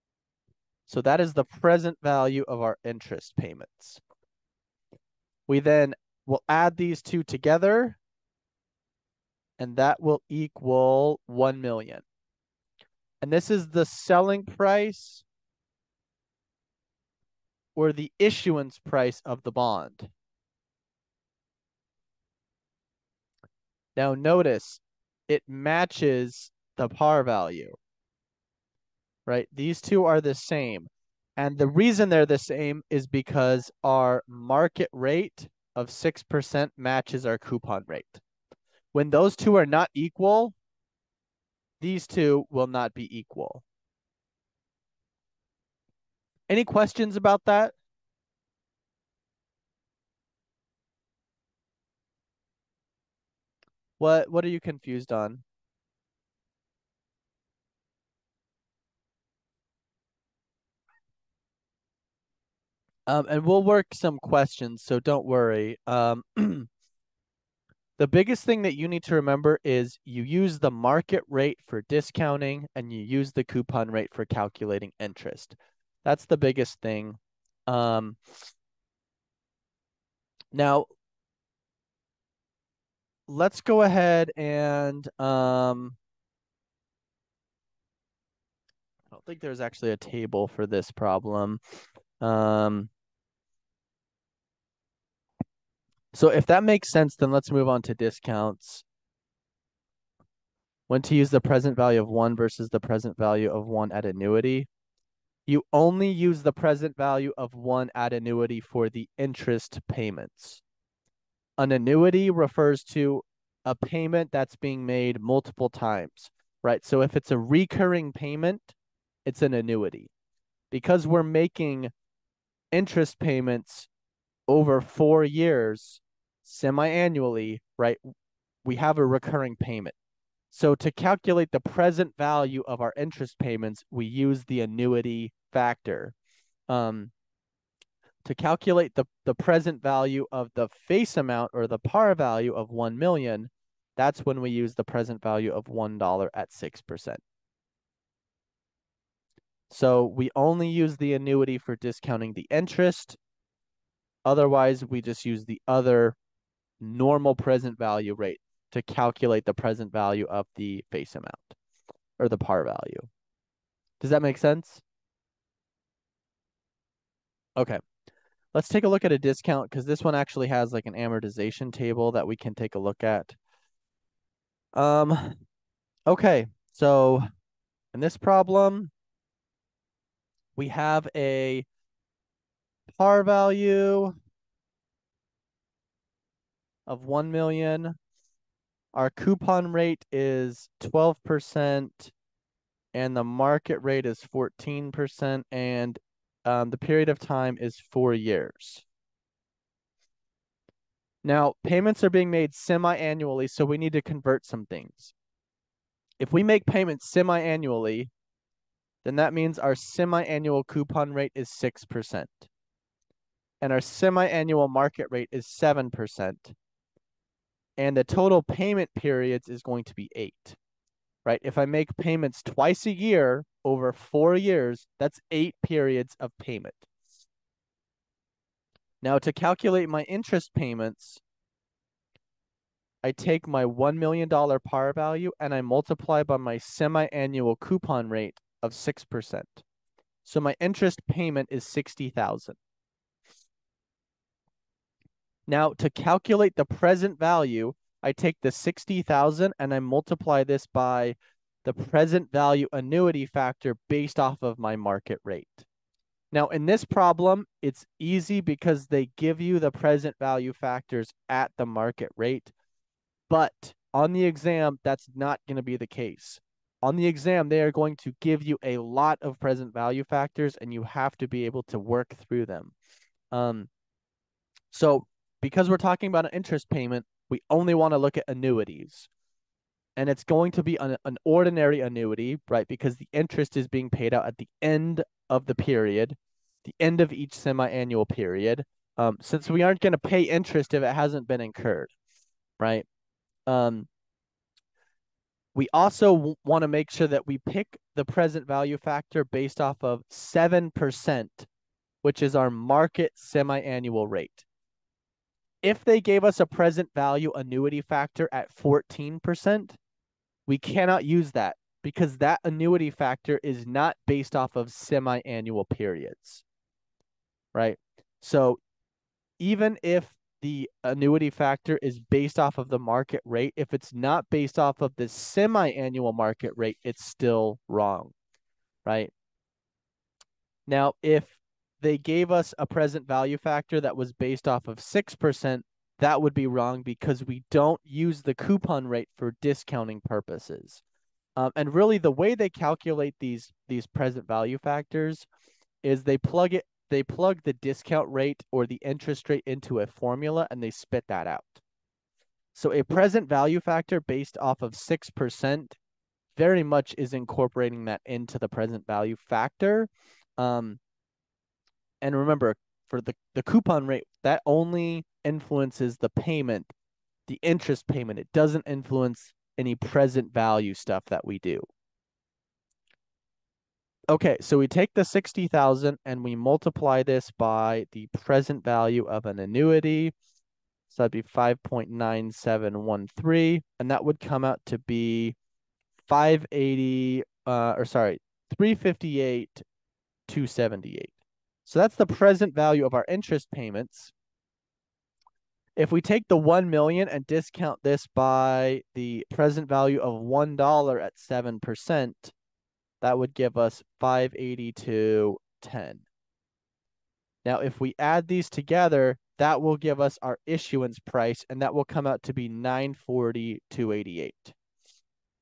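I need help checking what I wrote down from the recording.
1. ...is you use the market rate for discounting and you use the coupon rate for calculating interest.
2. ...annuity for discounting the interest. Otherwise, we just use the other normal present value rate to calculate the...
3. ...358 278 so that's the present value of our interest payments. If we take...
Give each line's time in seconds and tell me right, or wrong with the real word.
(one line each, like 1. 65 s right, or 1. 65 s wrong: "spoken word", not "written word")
1. 69 s right
2. 151 s right
3. 388 s right.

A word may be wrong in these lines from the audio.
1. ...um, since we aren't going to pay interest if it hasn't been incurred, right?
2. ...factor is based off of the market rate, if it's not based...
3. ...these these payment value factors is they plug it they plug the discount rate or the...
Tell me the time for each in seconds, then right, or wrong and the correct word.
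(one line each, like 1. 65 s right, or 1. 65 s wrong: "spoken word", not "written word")
1. 288 s right
2. 321 s right
3. 343 s wrong: "present", not "payment".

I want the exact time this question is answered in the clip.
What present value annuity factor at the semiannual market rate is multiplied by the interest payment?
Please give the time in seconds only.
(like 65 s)
381 s.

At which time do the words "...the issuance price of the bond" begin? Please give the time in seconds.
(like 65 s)
17 s.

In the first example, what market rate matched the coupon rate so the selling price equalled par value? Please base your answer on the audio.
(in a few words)
6%.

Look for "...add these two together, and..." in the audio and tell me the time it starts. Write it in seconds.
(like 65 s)
6 s.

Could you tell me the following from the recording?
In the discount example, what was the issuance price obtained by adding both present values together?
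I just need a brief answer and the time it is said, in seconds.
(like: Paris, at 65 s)
940,288, at 412 s.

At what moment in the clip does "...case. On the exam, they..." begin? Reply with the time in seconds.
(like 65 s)
265 s.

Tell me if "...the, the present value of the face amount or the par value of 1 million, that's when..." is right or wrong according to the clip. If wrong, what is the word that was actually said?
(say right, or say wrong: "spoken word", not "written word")
right.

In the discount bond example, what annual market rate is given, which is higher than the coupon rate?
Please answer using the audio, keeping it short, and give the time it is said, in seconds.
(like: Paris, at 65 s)
14%, at 193 s.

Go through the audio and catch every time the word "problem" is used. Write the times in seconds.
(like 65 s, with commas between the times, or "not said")
90 s, 178 s, 256 s.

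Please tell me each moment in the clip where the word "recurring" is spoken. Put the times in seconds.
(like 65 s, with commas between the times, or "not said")
117 s, 129 s.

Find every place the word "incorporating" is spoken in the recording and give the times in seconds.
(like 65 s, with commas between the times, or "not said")
357 s.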